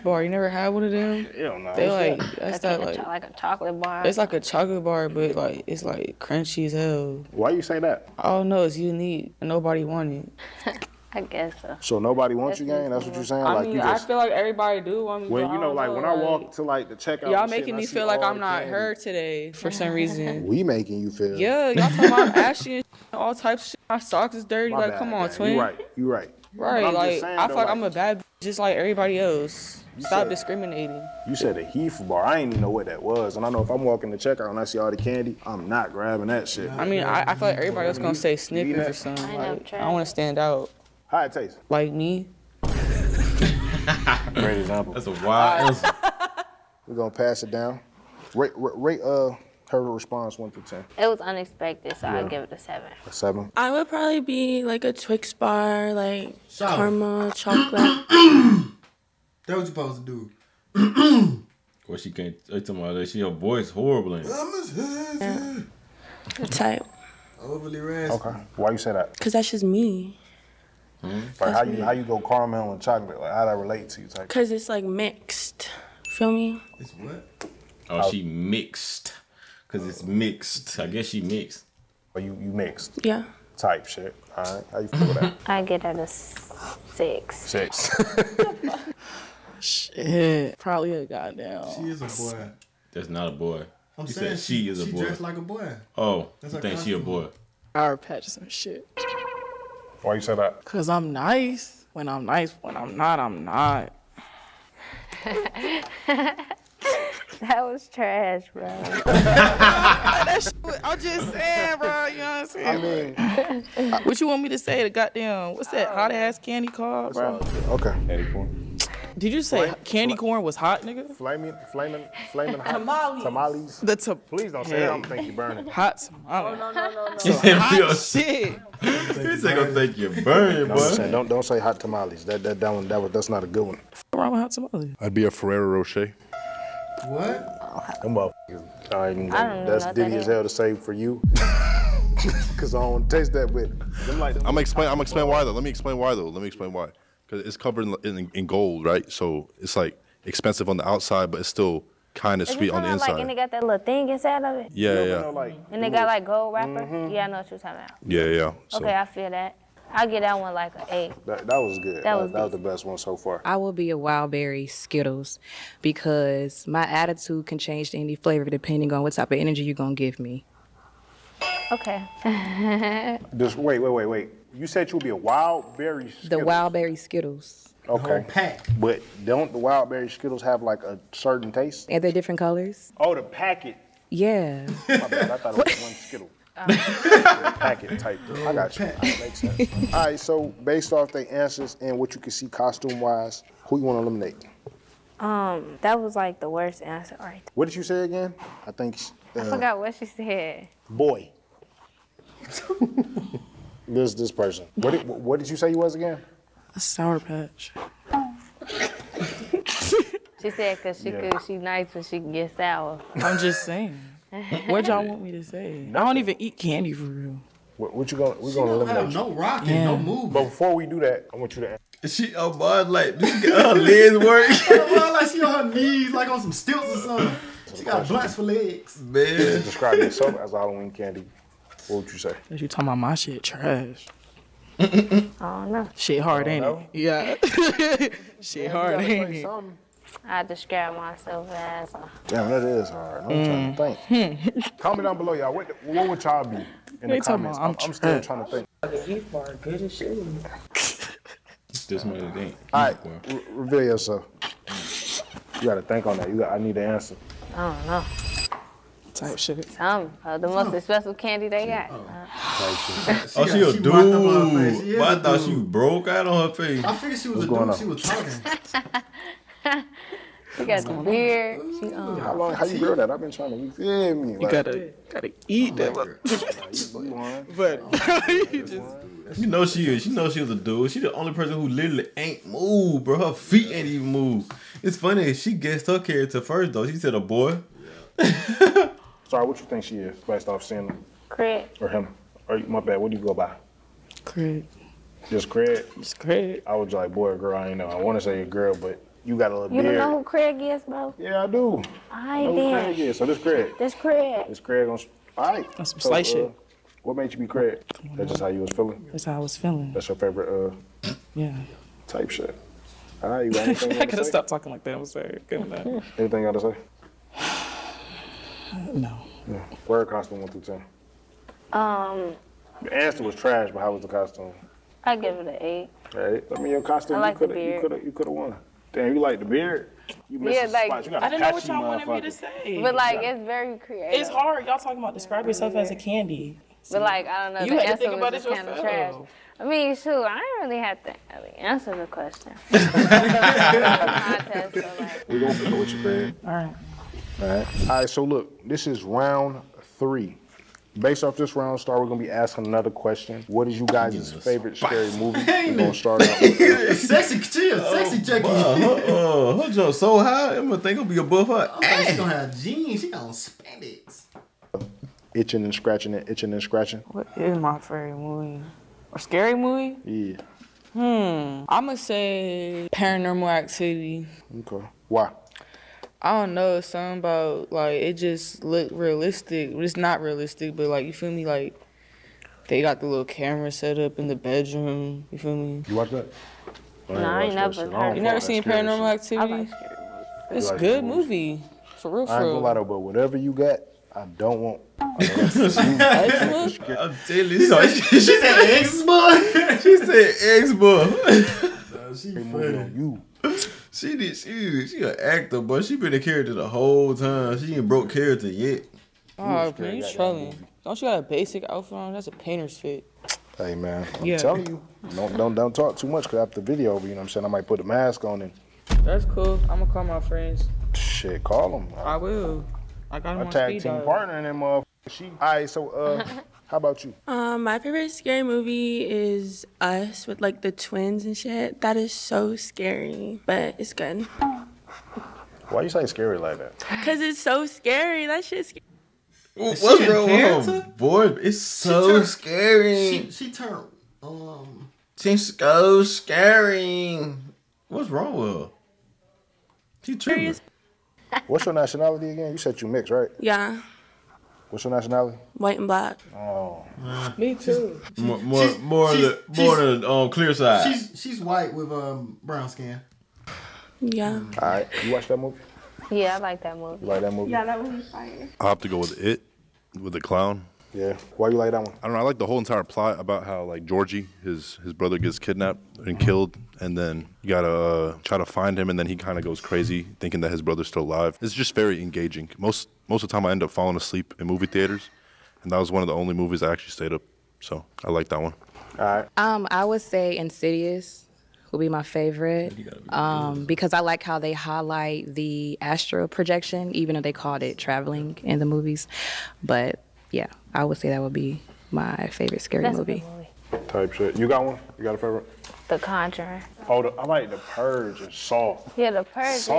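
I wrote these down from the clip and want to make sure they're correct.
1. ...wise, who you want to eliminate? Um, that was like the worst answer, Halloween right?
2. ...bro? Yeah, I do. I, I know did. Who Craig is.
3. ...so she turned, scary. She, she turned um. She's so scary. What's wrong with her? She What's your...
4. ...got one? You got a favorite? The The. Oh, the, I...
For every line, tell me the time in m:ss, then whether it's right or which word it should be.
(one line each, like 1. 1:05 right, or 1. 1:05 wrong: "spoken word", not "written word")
1. 3:13 wrong: "All", not "Halloween"
2. 5:00 right
3. 7:21 right
4. 8:24 wrong: "Conjuring", not "The".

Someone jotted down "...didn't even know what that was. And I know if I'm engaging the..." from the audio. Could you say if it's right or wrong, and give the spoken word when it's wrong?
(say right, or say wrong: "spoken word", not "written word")
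wrong: "walking", not "engaging".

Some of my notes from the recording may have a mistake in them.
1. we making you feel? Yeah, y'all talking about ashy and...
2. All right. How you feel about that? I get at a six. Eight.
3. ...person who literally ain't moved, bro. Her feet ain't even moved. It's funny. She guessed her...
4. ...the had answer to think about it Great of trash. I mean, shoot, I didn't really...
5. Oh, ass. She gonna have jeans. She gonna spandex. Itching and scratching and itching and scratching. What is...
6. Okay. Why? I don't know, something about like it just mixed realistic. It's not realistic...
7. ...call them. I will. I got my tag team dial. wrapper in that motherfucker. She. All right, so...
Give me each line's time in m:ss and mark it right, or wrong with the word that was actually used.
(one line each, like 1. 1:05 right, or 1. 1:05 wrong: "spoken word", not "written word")
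1. 0:20 right
2. 1:24 wrong: "Six", not "Eight"
3. 4:41 right
4. 5:37 wrong: "Kind", not "Great"
5. 6:01 right
6. 6:14 wrong: "looked", not "mixed"
7. 7:01 wrong: "partner", not "wrapper".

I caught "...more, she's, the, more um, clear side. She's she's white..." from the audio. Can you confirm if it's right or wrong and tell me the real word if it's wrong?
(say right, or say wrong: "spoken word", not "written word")
right.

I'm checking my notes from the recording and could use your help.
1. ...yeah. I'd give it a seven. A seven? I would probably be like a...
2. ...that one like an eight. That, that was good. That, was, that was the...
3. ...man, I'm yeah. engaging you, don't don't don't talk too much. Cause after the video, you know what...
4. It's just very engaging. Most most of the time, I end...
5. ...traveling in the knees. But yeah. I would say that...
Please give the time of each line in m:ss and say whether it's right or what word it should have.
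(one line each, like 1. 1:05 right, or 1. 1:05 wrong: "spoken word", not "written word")
1. 0:52 right
2. 2:40 right
3. 6:53 wrong: "telling", not "engaging"
4. 8:01 right
5. 8:17 wrong: "movies", not "knees".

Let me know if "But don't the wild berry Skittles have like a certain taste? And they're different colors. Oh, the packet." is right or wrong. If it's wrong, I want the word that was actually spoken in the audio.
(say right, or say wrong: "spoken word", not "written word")
right.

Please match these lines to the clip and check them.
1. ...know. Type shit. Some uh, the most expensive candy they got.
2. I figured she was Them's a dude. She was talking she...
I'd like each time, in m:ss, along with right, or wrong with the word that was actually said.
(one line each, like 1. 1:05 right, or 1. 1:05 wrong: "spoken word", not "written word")
1. 4:17 right
2. 4:26 wrong: "What", not "Them".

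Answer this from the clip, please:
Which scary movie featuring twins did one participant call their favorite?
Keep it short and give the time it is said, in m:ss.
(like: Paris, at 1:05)
Us, at 7:09.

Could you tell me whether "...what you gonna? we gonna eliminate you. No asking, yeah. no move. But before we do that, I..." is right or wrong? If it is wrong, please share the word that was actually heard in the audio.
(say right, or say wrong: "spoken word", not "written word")
wrong: "rocking", not "asking".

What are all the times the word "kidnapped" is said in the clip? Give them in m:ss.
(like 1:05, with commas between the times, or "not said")
7:55.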